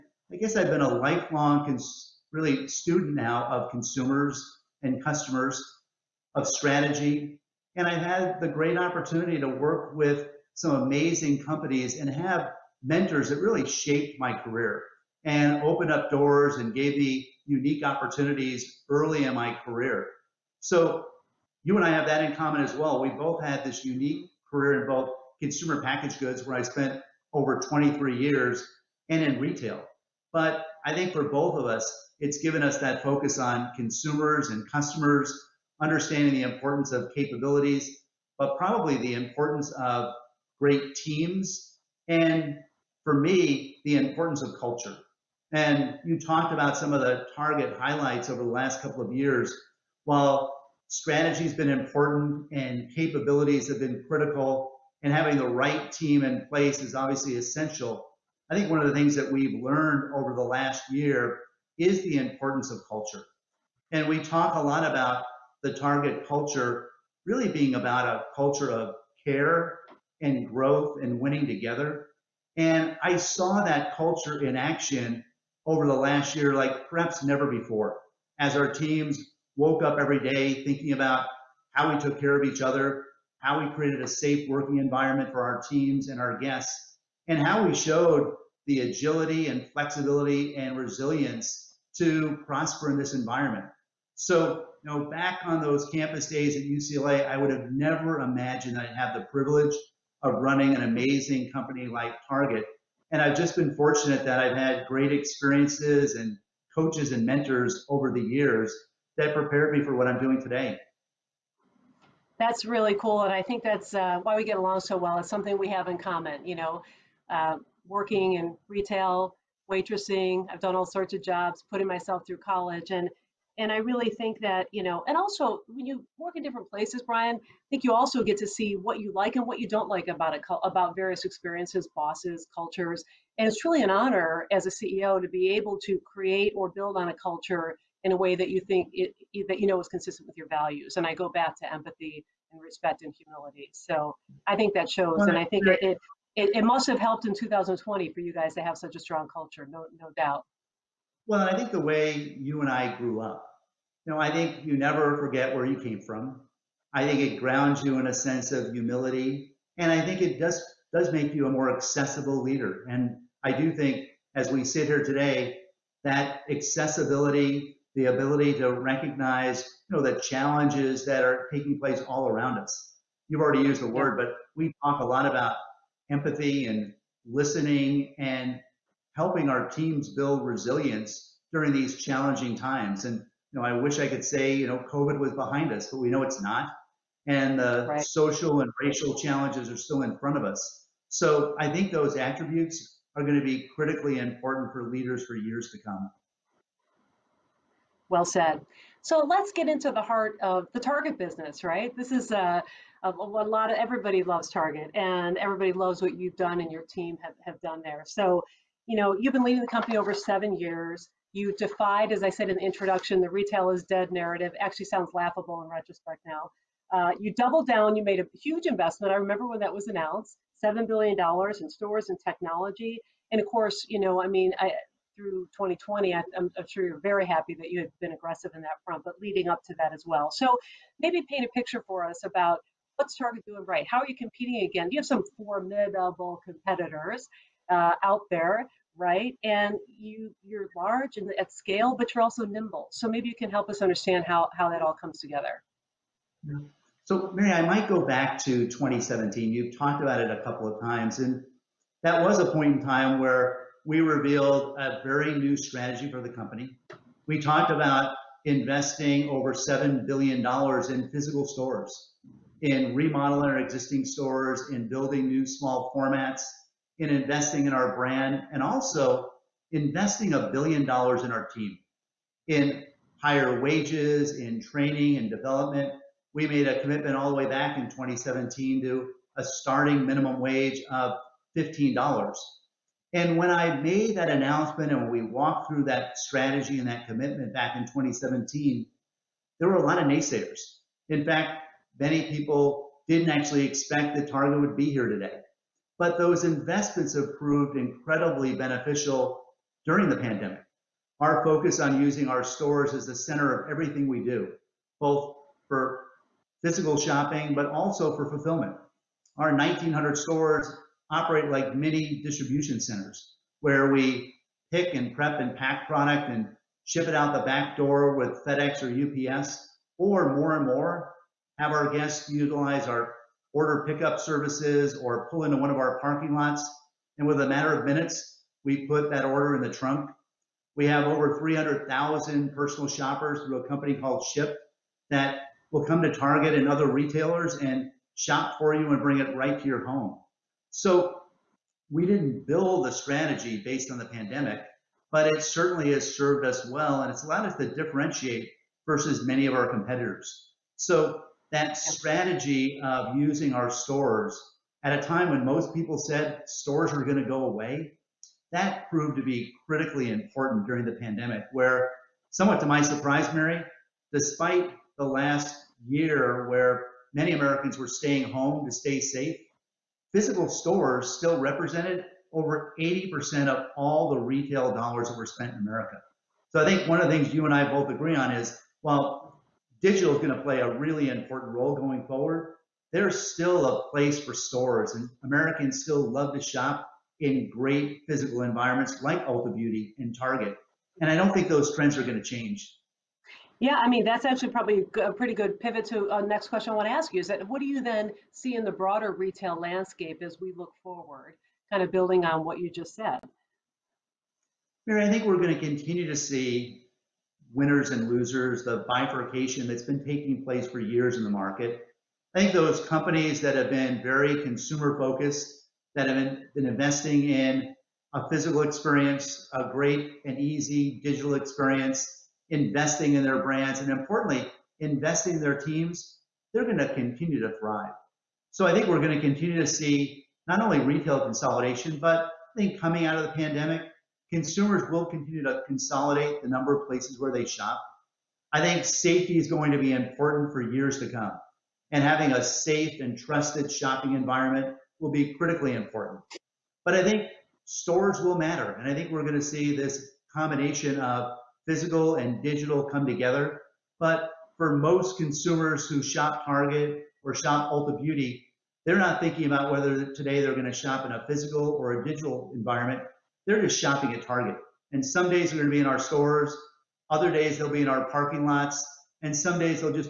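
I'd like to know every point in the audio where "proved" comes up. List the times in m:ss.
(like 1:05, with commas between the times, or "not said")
4:57, 5:58.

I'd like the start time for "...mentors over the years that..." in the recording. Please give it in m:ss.
1:47.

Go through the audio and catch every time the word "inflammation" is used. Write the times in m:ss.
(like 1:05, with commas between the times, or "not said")
not said.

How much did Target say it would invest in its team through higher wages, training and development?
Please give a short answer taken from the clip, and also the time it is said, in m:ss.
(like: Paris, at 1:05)
$1 billion, at 4:30.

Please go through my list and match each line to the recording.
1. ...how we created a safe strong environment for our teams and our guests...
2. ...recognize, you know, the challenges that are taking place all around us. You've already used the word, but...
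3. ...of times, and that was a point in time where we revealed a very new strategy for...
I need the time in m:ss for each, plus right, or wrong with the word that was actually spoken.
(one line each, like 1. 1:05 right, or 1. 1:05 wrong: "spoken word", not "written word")
1. 1:23 wrong: "working", not "strong"
2. 2:48 right
3. 4:10 right.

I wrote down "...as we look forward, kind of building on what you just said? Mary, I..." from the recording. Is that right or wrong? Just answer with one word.
right.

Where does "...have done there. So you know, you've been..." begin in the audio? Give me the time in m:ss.
3:27.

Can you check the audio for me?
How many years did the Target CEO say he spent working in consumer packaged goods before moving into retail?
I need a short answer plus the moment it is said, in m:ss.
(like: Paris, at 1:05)
23 years, at 0:27.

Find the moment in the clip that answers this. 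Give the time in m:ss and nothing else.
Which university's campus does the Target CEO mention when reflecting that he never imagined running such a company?
1:36.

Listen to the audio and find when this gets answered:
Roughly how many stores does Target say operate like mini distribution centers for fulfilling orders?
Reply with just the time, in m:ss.
5:09.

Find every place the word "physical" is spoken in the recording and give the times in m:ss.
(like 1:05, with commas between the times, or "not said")
4:21, 5:06, 6:10, 6:28, 6:58, 7:31, 7:41.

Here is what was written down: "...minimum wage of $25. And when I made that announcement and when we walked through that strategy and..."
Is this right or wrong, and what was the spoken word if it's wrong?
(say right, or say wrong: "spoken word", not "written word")
wrong: "15", not "25".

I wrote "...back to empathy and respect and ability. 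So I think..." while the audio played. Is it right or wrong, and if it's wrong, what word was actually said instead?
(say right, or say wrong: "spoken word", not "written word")
wrong: "humility", not "ability".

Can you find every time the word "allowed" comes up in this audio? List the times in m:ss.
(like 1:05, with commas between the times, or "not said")
5:47.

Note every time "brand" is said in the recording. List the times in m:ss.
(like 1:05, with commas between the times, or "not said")
4:27, 7:03.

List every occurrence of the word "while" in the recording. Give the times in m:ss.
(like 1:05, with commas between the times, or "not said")
0:50, 6:18.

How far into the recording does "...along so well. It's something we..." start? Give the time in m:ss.
1:54.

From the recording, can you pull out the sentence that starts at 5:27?
And with a matter of minutes, we put that order in the trunk.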